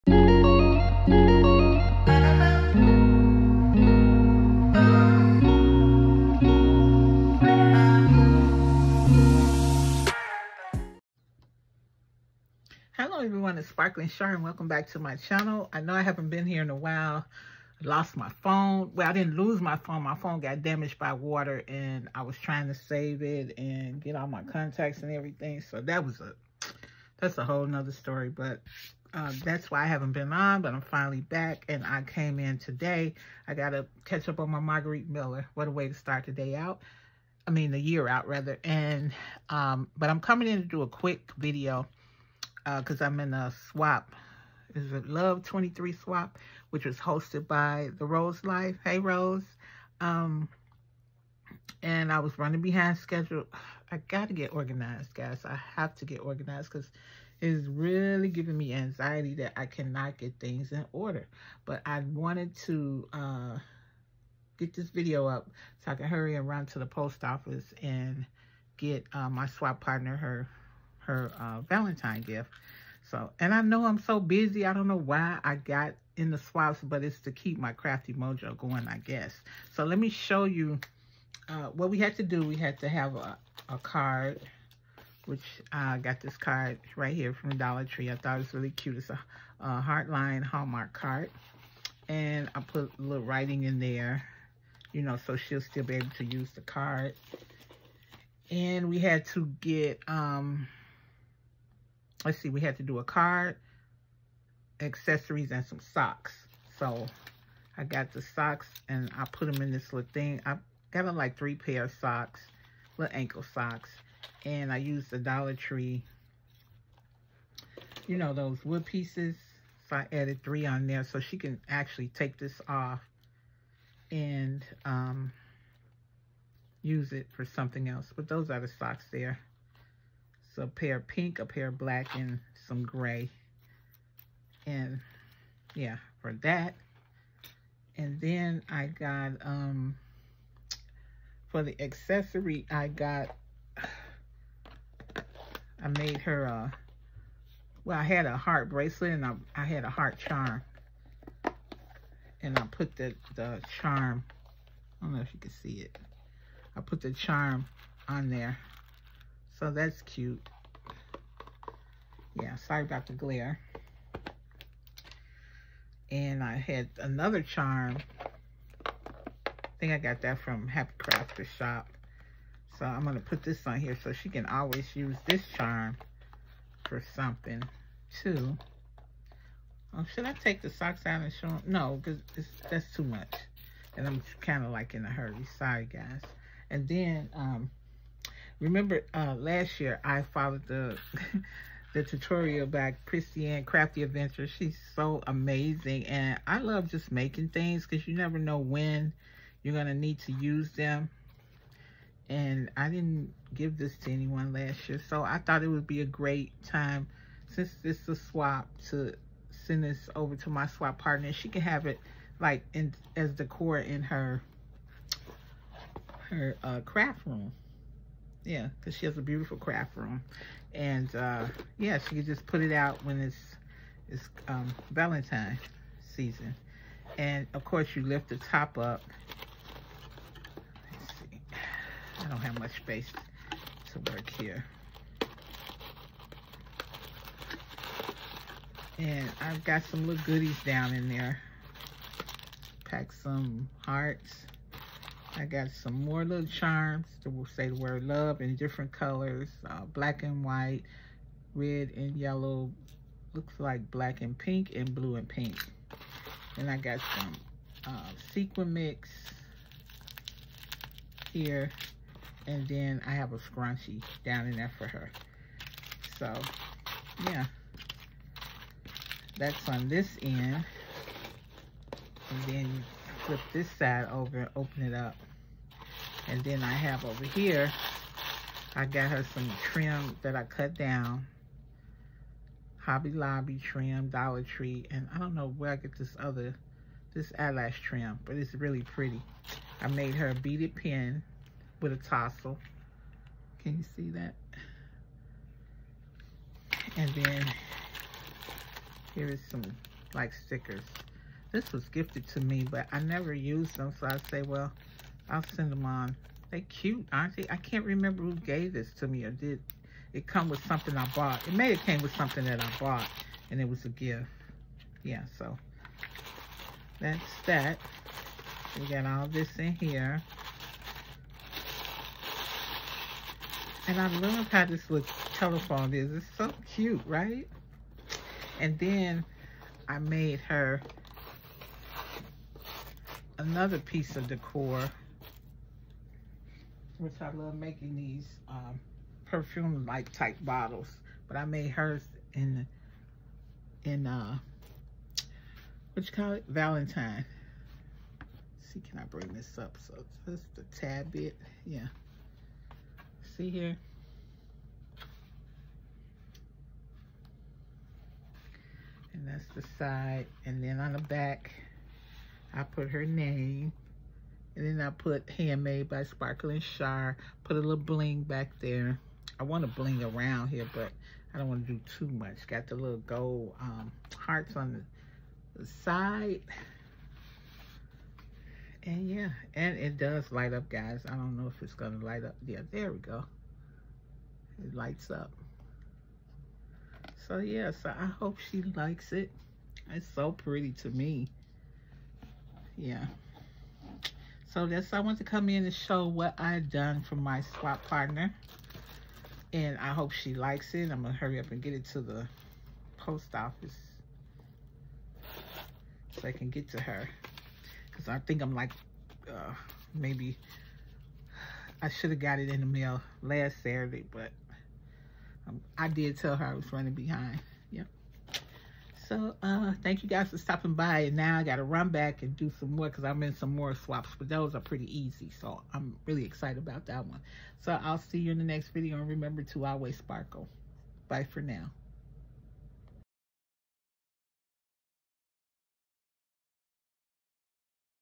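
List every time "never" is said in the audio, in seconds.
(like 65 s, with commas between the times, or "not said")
198 s, 302 s.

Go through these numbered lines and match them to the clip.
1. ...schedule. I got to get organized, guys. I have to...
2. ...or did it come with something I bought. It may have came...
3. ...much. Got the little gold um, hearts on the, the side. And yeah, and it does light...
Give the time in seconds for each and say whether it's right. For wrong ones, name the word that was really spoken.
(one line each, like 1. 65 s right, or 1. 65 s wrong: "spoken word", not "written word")
1. 52 s right
2. 309 s right
3. 372 s right.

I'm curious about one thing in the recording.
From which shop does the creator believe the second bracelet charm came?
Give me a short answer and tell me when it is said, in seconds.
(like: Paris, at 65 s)
Happy Crafter Shop, at 170 s.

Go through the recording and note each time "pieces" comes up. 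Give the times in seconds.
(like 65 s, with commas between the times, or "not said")
118 s, 333 s.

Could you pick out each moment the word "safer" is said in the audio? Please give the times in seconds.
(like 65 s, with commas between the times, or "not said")
not said.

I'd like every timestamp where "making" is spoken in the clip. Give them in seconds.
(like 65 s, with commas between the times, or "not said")
197 s, 337 s.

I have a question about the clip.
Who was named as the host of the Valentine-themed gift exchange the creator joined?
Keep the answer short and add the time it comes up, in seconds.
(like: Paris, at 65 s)
The Rose Life, at 47 s.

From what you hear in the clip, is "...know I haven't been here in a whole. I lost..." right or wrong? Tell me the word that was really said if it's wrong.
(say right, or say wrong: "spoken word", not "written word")
wrong: "while", not "whole".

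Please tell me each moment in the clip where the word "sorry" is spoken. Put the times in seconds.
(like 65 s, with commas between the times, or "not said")
162 s, 185 s.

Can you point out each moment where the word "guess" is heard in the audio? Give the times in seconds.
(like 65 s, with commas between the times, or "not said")
78 s.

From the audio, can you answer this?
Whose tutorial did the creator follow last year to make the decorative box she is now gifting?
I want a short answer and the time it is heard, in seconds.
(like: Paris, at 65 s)
Christiane Crafty Adventures, at 193 s.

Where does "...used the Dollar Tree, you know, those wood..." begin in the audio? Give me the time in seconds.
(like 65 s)
114 s.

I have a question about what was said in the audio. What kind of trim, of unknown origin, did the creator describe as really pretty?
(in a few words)
Eyelash trim.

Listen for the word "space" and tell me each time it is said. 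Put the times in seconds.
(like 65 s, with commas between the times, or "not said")
232 s.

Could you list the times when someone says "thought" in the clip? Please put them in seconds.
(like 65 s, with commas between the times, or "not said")
88 s, 205 s.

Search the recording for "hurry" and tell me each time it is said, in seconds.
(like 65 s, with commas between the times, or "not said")
66 s, 185 s, 401 s.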